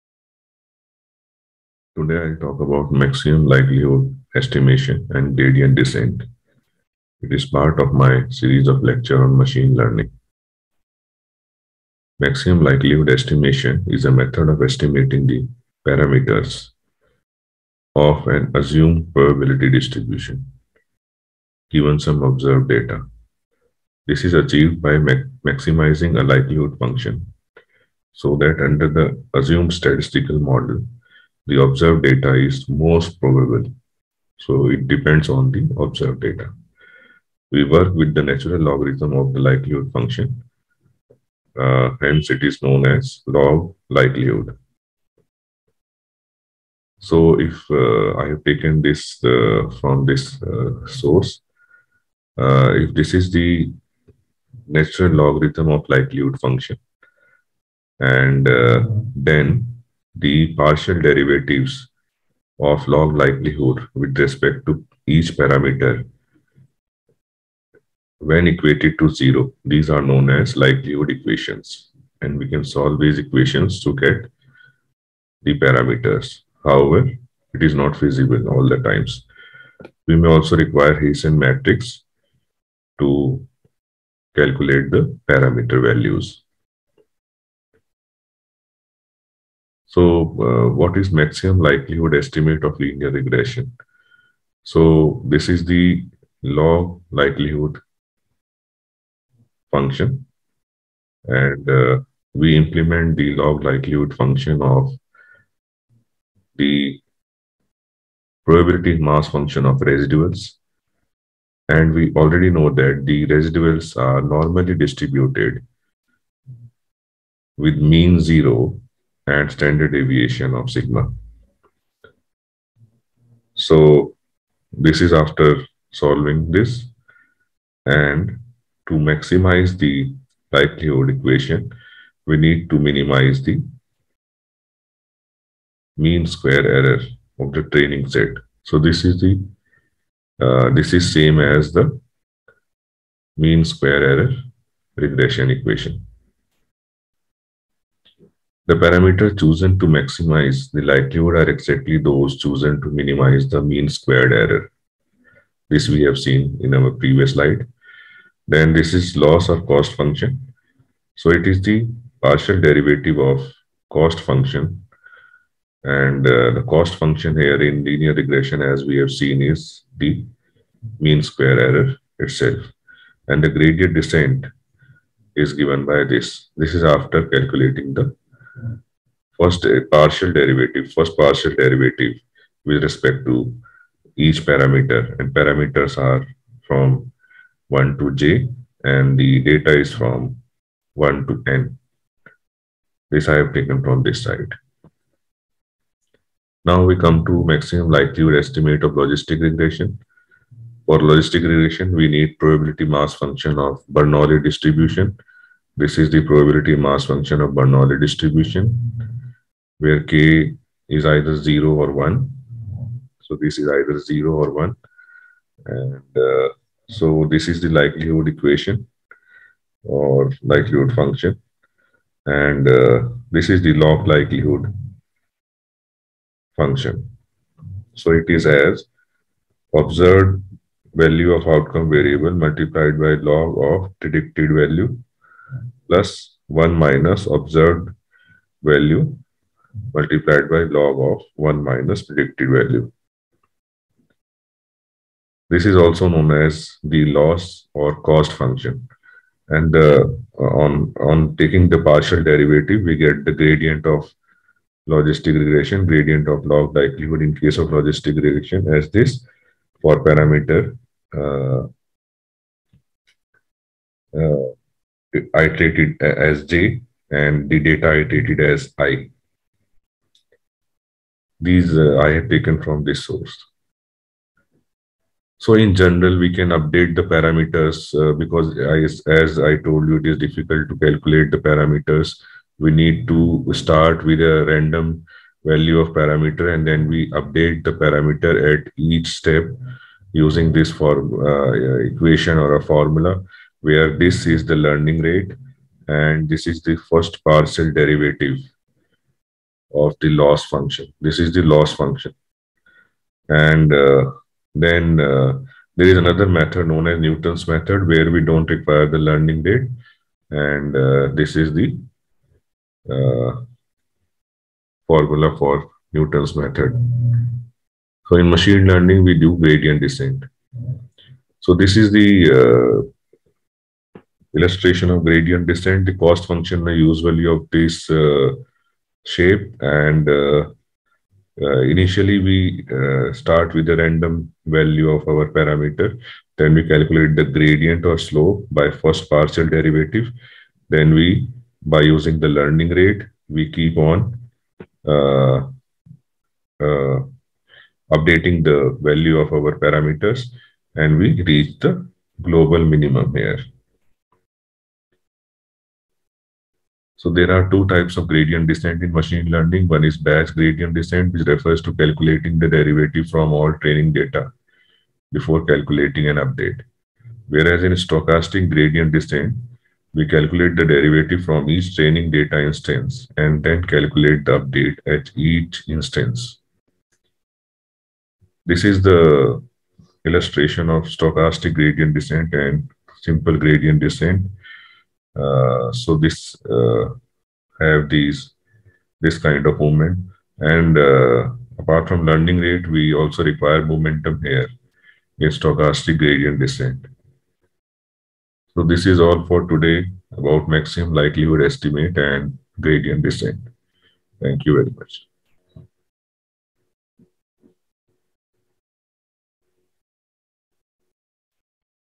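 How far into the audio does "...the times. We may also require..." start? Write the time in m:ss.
1:18.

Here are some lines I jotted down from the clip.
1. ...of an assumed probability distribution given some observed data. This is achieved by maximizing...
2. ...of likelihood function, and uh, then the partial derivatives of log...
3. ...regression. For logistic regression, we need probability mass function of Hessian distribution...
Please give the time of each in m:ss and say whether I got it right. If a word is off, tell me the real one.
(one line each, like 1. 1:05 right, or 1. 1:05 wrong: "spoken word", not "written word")
1. 0:17 right
2. 0:55 right
3. 3:19 wrong: "Bernoulli", not "Hessian".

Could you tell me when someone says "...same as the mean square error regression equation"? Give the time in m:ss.
2:21.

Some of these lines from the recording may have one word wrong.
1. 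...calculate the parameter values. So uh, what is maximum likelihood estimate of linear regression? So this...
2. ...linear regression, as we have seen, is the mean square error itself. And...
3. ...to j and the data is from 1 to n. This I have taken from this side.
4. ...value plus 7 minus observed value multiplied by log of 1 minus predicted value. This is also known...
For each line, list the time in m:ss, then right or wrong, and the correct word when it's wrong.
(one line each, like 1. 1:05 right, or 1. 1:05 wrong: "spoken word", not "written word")
1. 1:24 right
2. 2:47 right
3. 3:07 right
4. 3:54 wrong: "1", not "7".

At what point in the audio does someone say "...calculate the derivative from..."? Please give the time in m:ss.
6:10.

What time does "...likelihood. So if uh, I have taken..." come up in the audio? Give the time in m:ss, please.
0:43.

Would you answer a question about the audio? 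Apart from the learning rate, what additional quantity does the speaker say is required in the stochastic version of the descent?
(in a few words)
momentum.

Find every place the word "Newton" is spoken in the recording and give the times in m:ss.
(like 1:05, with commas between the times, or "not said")
5:06, 5:15.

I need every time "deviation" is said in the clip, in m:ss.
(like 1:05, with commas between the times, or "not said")
1:59.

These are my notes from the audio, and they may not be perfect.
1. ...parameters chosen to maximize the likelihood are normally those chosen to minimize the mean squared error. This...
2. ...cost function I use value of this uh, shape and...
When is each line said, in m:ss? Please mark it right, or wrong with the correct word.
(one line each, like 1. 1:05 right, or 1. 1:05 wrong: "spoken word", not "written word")
1. 2:28 wrong: "exactly", not "normally"
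2. 5:25 right.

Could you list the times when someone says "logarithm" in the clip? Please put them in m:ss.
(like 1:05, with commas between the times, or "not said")
0:38, 0:55.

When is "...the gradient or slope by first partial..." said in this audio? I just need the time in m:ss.
5:37.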